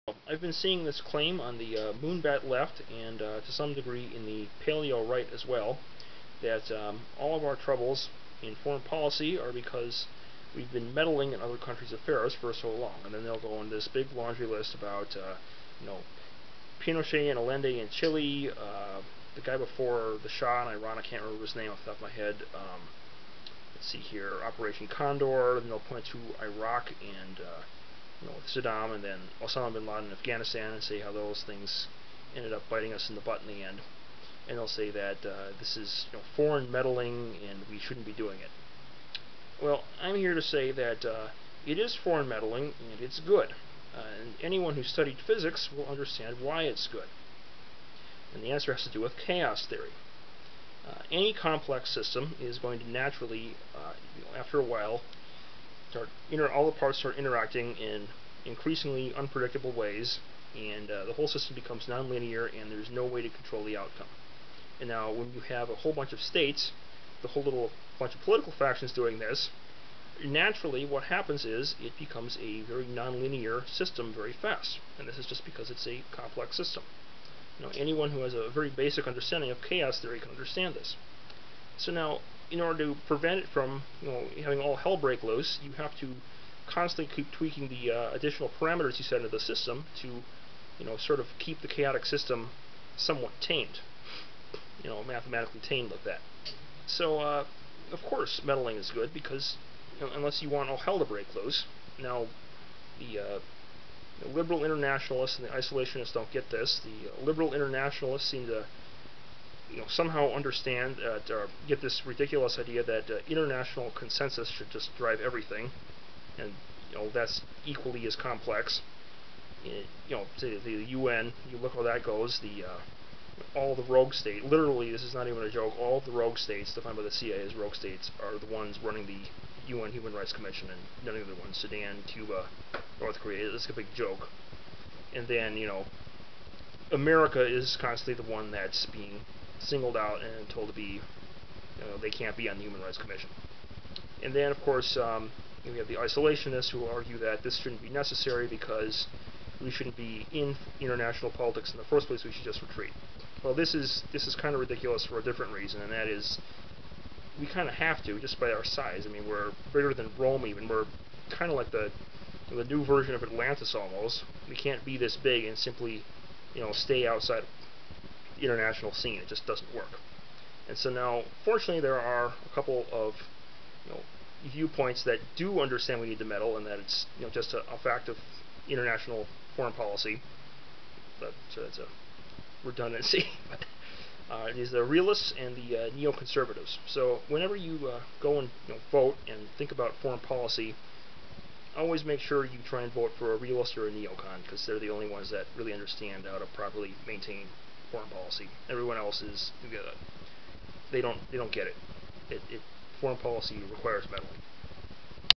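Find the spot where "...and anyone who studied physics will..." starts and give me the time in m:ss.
0:44.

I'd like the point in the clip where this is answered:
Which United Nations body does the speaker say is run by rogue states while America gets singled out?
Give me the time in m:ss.
2:09.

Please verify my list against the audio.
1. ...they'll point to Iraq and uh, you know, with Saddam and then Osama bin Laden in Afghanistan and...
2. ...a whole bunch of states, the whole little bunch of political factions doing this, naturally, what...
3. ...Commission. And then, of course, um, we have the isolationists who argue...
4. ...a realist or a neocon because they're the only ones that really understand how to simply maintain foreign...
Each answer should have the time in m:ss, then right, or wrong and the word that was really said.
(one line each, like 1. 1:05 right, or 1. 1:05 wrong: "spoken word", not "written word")
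1. 0:25 right
2. 1:05 right
3. 2:22 right
4. 3:13 wrong: "properly", not "simply".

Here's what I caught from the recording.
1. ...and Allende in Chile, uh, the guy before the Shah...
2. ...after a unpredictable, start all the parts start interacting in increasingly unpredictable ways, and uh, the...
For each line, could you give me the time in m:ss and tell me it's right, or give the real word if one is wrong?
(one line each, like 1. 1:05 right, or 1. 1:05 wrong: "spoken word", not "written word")
1. 0:17 right
2. 0:54 wrong: "while", not "unpredictable".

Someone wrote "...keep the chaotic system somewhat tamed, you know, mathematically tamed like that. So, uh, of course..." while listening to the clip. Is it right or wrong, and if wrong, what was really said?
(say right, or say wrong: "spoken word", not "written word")
right.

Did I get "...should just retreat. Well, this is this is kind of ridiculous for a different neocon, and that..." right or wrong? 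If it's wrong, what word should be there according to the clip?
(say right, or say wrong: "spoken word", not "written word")
wrong: "reason", not "neocon".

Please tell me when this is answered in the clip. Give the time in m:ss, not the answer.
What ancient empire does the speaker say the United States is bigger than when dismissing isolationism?
2:40.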